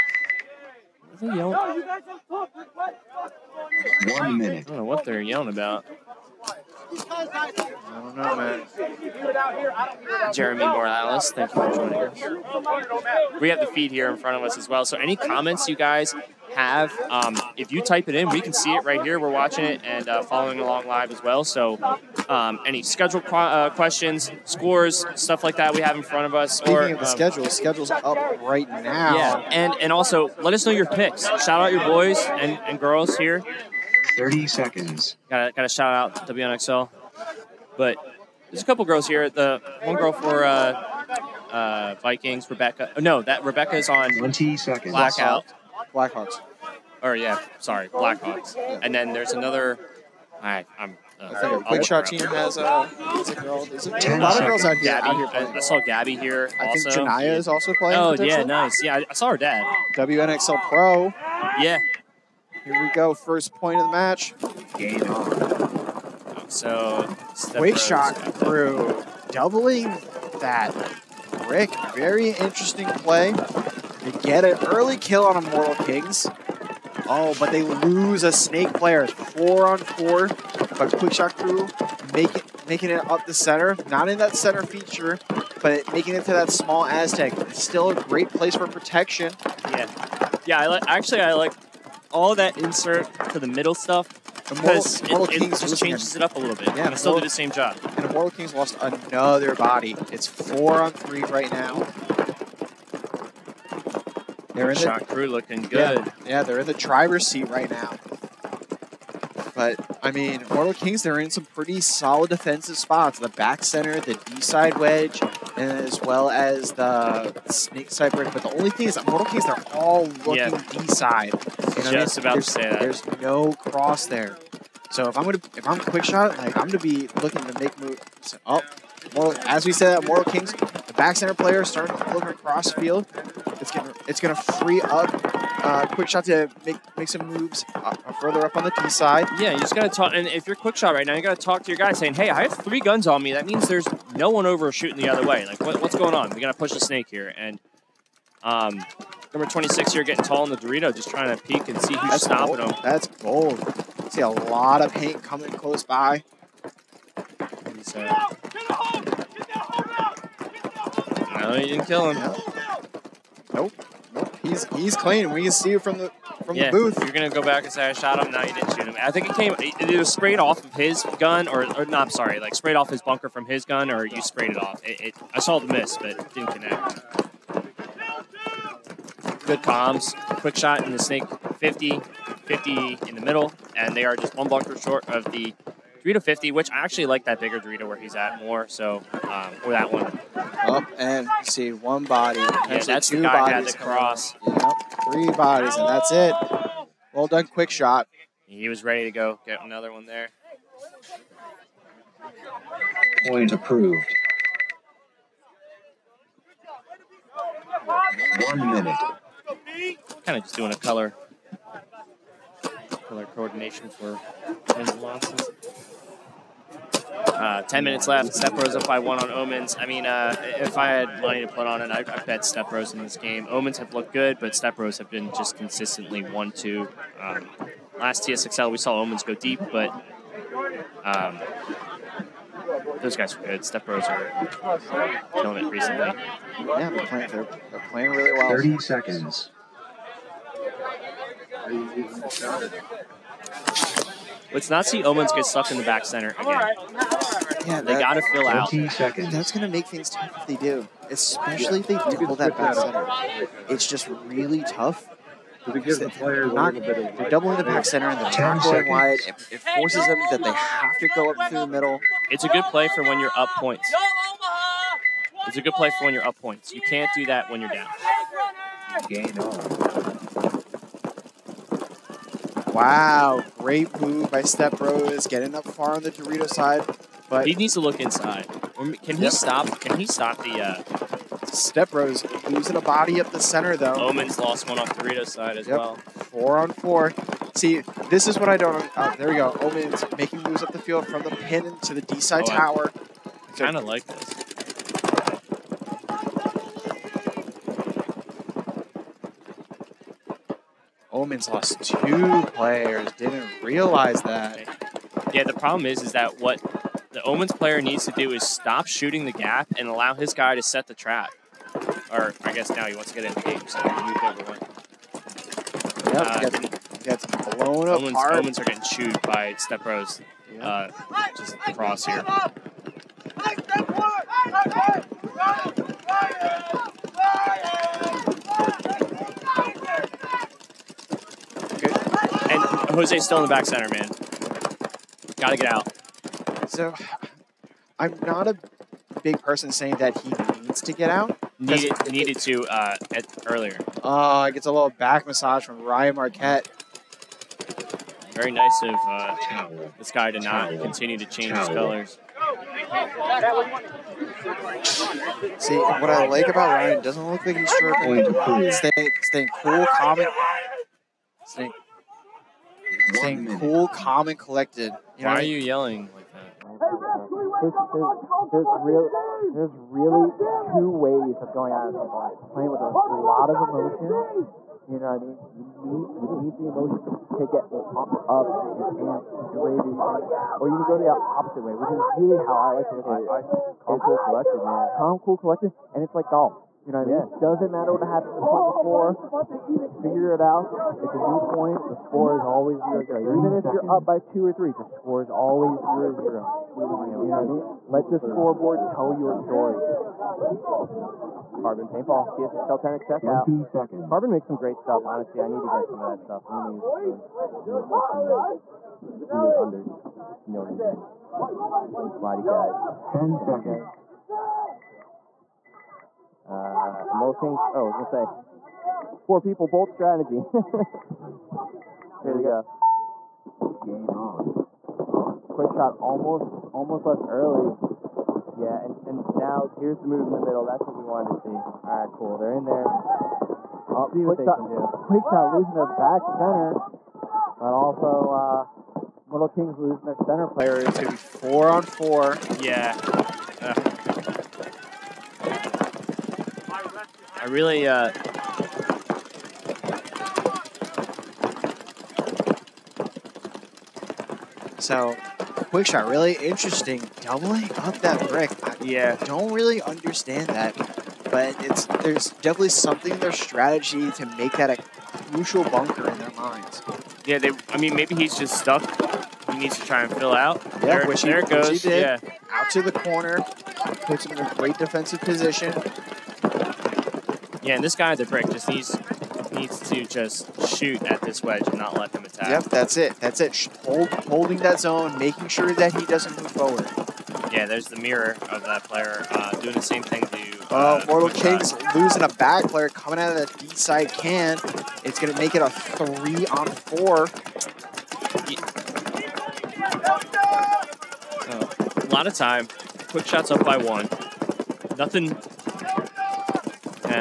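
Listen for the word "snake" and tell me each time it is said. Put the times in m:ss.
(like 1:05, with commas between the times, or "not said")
1:18, 1:57, 2:26, 3:00.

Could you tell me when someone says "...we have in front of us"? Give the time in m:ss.
0:25.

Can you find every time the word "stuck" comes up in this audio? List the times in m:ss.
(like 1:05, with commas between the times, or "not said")
4:05, 7:48.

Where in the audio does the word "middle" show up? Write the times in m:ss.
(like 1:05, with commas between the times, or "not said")
1:33, 3:03, 4:21, 7:10.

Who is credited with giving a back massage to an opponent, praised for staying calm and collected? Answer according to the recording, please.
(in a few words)
Ryan Marquette.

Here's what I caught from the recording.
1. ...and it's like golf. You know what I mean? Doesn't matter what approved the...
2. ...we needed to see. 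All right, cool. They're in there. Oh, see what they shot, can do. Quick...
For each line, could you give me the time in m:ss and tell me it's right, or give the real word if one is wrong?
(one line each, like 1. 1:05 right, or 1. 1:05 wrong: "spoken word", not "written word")
1. 6:25 wrong: "happened", not "approved"
2. 7:10 wrong: "wanted", not "needed".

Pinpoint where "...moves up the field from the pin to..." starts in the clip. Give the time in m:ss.
4:50.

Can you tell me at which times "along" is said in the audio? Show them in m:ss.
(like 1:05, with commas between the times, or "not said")
0:20.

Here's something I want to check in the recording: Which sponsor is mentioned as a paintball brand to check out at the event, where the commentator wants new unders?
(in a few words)
Carbon paintball.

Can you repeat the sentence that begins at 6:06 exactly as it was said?
Hey, there's, there's, there's, real, there's really two ways of going out of people.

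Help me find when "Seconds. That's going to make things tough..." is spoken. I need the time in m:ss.
4:08.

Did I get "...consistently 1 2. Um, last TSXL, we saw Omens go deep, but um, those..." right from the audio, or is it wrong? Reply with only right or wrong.
right.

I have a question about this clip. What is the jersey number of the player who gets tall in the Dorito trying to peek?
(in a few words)
26.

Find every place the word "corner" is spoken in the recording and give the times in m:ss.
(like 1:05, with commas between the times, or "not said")
7:52.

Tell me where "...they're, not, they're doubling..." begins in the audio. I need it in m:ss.
4:15.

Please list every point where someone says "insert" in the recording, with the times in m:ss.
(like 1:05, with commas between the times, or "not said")
1:32.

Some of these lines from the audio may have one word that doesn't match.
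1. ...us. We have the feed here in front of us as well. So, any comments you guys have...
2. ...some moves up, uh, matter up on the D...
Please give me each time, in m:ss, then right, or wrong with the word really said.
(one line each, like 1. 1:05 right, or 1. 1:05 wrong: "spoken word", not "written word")
1. 0:12 right
2. 2:17 wrong: "further", not "matter".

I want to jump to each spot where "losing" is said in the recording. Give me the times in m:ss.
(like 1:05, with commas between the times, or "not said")
4:42, 7:15, 7:19, 8:11.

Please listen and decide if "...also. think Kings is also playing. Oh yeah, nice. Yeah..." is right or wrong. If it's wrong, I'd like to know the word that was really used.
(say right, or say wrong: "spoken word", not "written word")
wrong: "Janaya", not "Kings".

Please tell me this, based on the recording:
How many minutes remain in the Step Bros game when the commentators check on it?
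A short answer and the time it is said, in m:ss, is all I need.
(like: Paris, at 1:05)
10, at 3:37.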